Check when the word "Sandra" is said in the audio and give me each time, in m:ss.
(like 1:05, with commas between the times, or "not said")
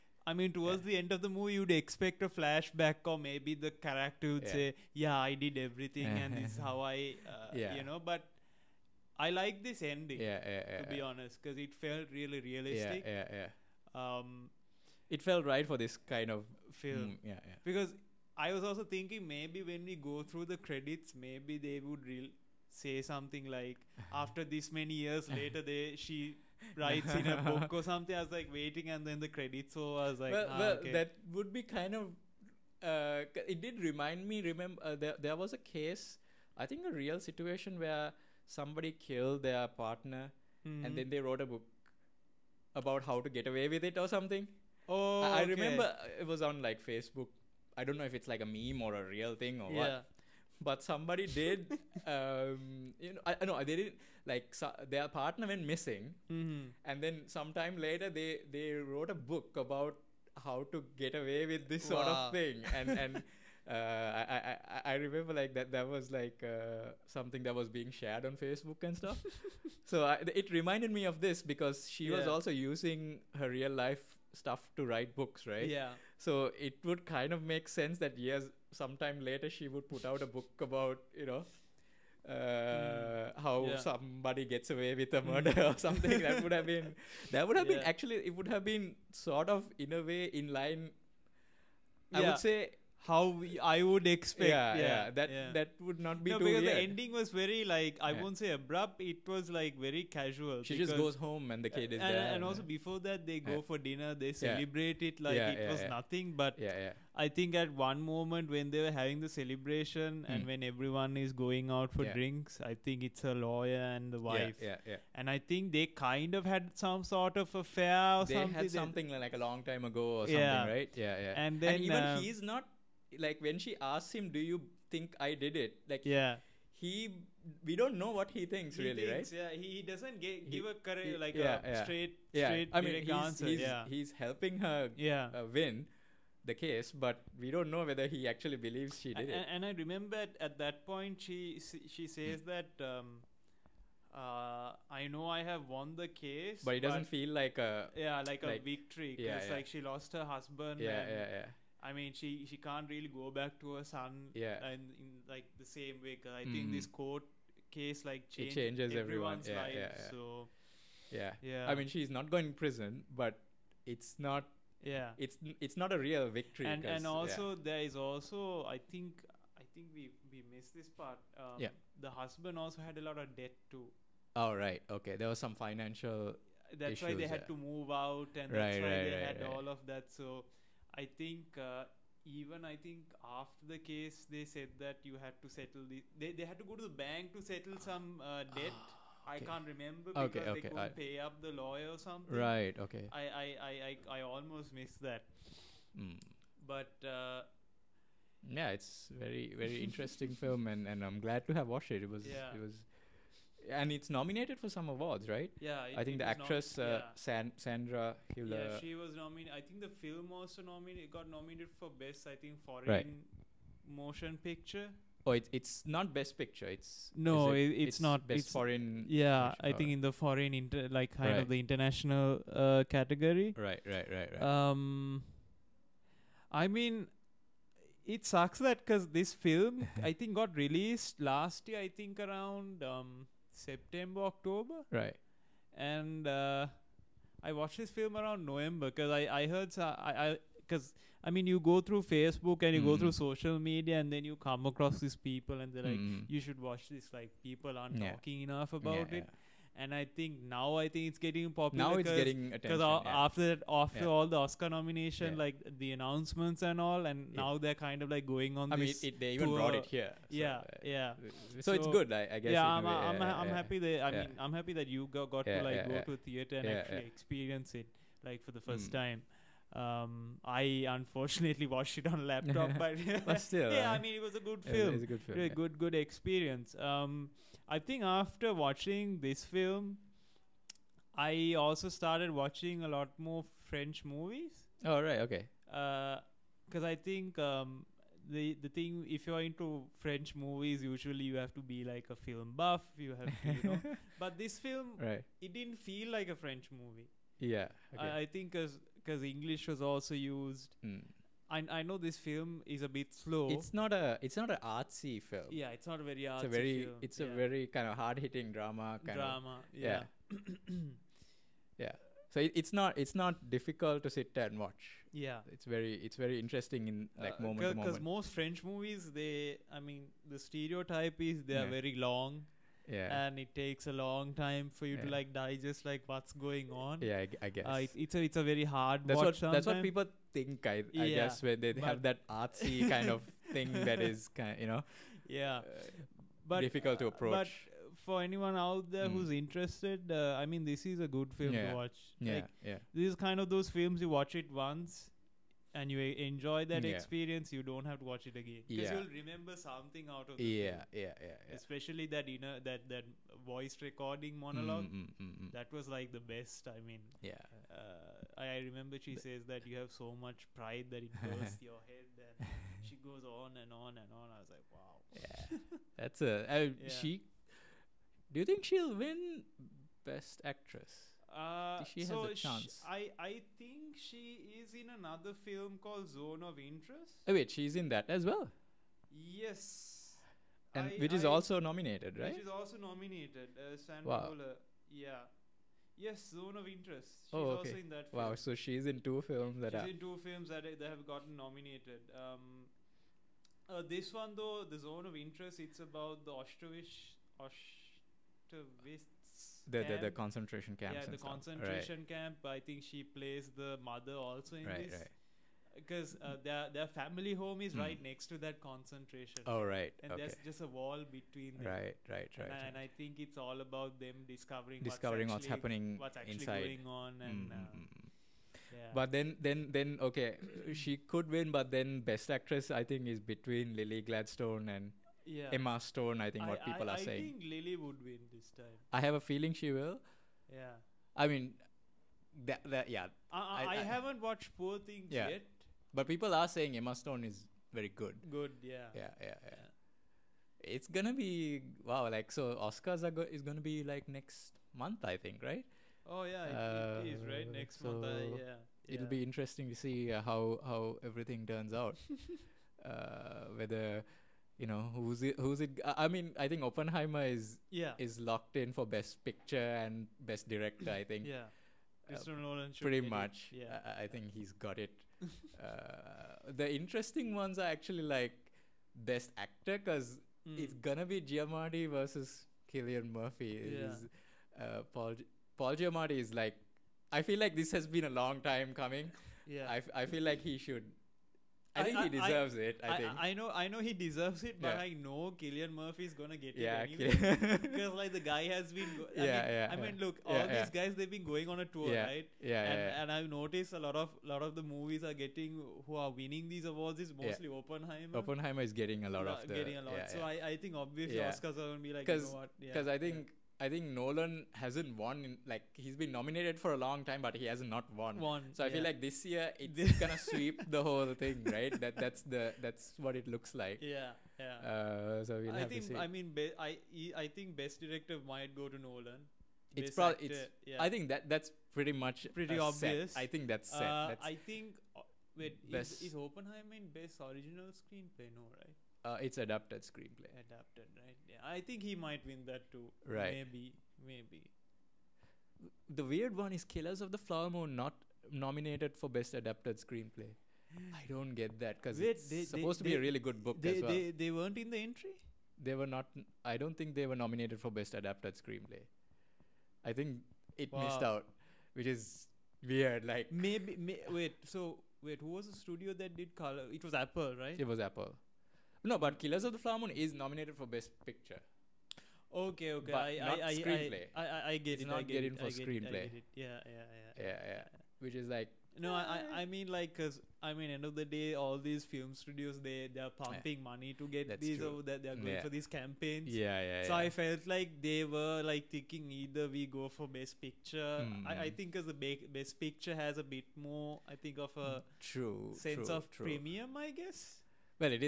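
3:27, 6:23.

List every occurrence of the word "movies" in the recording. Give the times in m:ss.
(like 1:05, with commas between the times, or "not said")
0:01, 4:44, 4:50, 4:56, 5:18, 8:14.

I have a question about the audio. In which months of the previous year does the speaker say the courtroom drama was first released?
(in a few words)
September, October.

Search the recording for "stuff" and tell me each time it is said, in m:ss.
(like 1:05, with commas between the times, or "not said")
1:08, 1:14, 6:41.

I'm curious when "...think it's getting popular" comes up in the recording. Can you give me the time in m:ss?
4:10.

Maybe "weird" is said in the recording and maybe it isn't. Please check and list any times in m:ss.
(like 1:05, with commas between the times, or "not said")
1:36, 8:56, 9:12.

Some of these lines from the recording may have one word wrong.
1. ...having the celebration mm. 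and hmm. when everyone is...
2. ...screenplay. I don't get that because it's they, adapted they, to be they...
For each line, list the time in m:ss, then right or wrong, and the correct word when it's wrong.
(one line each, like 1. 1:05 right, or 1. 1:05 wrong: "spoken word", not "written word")
1. 1:48 right
2. 8:59 wrong: "supposed", not "adapted".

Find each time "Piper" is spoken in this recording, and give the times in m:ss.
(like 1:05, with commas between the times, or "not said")
not said.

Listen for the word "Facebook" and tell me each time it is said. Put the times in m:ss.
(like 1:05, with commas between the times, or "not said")
0:46, 1:08, 4:02.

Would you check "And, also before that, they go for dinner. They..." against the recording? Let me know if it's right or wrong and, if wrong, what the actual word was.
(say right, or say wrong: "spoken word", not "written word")
right.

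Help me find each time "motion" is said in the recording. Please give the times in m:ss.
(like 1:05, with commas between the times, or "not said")
3:33.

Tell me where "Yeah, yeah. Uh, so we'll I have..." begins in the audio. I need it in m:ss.
8:33.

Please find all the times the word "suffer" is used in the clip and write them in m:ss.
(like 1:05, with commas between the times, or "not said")
not said.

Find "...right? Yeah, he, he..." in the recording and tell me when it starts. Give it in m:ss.
2:09.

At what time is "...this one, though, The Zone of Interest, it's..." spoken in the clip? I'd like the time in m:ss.
6:33.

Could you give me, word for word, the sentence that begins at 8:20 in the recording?
so I, I think obviously Oscars are gonna be like you know what?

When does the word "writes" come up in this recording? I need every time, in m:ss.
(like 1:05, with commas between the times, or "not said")
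0:26, 1:14.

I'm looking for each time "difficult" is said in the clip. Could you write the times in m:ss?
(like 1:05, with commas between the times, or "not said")
5:13, 5:36.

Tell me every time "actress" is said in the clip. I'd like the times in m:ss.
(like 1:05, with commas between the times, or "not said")
3:26, 6:10, 7:02.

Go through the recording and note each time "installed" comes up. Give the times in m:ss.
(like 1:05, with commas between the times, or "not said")
not said.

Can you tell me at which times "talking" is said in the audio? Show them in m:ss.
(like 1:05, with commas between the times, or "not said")
4:08.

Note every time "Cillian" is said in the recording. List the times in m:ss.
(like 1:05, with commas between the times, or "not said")
7:52, 8:05.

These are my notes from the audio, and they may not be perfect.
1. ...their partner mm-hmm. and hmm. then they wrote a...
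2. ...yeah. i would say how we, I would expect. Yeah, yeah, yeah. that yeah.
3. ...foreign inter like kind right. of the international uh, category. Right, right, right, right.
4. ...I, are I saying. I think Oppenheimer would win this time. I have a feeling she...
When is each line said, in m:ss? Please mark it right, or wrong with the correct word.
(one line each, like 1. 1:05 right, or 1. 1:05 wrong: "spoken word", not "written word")
1. 0:39 right
2. 1:32 right
3. 3:40 right
4. 7:06 wrong: "Lily", not "Oppenheimer".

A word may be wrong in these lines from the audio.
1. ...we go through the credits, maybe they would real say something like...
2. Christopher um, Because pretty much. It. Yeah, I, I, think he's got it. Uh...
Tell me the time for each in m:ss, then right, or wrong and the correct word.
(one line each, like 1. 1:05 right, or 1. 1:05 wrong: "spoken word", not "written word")
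1. 0:19 right
2. 7:42 wrong: "Nolan", not "Because".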